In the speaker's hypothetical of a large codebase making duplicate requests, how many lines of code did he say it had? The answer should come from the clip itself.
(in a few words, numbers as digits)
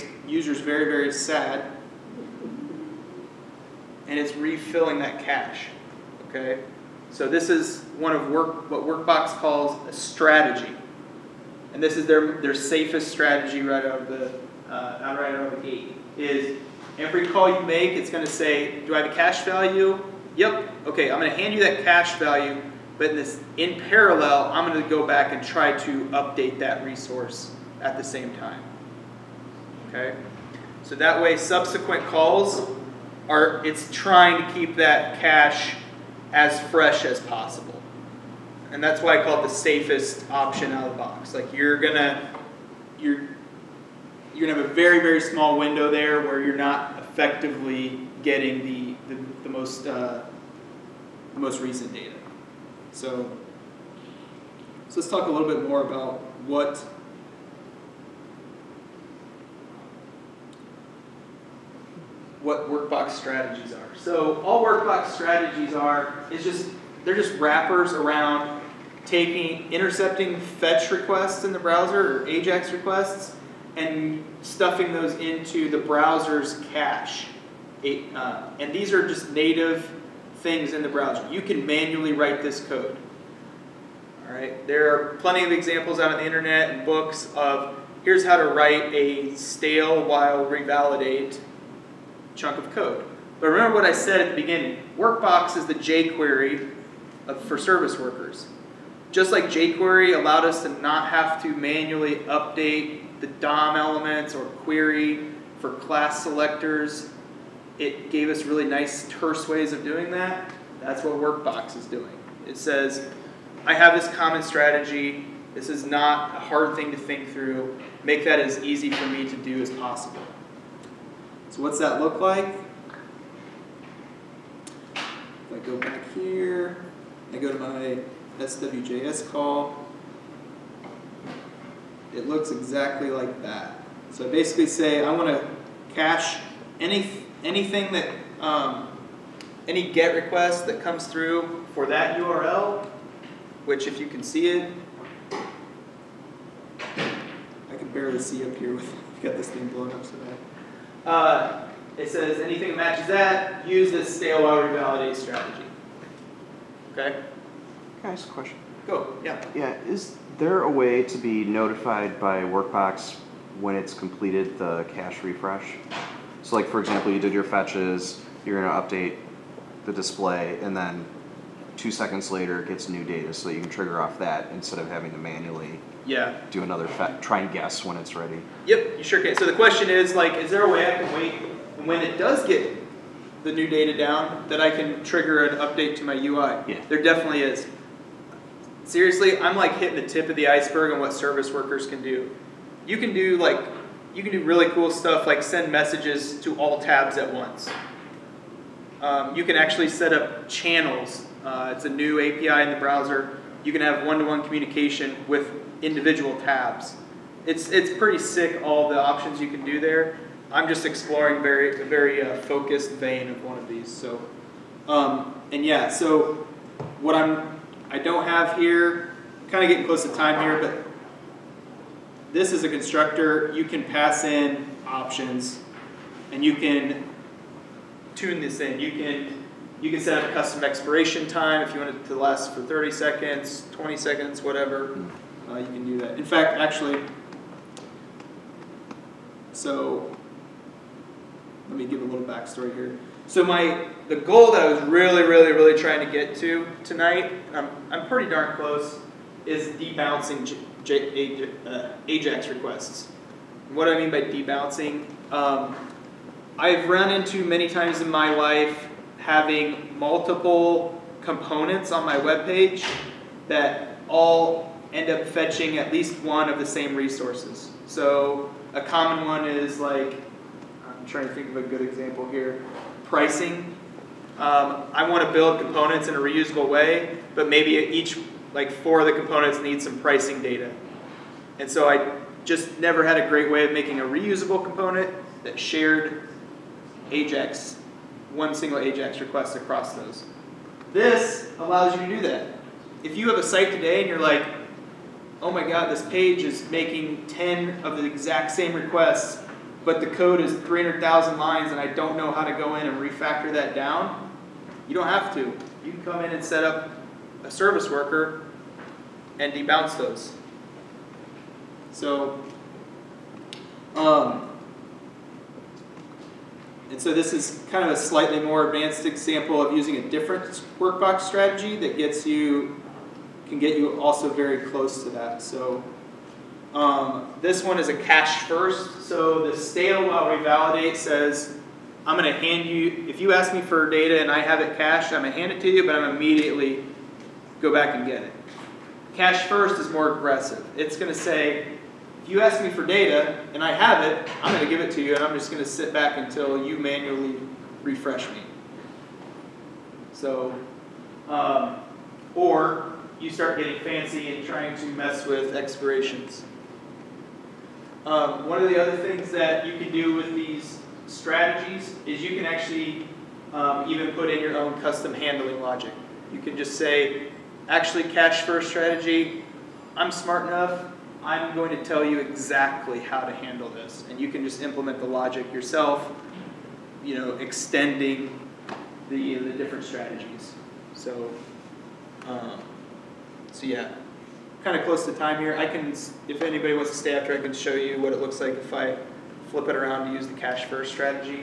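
300,000.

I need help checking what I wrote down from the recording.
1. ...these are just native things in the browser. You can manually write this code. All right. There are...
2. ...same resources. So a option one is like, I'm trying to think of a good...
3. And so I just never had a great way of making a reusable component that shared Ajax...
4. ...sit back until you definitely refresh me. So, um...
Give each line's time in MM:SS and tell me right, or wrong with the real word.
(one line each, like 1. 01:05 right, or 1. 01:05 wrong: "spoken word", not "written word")
1. 01:18 right
2. 04:26 wrong: "common", not "option"
3. 04:41 right
4. 05:45 wrong: "manually", not "definitely".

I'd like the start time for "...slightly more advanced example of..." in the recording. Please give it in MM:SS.
05:17.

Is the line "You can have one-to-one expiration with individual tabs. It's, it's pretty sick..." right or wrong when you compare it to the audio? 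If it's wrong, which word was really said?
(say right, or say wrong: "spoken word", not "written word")
wrong: "communication", not "expiration".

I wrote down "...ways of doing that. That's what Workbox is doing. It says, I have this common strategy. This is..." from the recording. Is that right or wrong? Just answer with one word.
right.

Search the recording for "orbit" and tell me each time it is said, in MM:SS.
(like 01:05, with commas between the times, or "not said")
not said.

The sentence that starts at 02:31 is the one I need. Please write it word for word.
Uh, it says anything that matches that, use this stale while revalidate strategy.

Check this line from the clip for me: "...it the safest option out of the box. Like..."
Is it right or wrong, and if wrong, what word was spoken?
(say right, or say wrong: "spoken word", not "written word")
right.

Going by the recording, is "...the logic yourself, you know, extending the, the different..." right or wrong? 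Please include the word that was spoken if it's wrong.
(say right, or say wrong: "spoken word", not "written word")
right.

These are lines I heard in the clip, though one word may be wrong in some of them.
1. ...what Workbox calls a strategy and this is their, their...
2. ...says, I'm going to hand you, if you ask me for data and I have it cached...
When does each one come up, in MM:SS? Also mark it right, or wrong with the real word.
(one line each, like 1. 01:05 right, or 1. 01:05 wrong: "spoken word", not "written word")
1. 00:08 right
2. 05:30 right.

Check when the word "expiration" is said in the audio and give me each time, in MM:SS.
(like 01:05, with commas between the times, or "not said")
03:50, 05:55.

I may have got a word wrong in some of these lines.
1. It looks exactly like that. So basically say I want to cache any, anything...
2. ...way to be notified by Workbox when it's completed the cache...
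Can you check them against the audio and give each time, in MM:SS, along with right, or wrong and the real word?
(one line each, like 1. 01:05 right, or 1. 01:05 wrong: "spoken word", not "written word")
1. 02:12 right
2. 02:40 right.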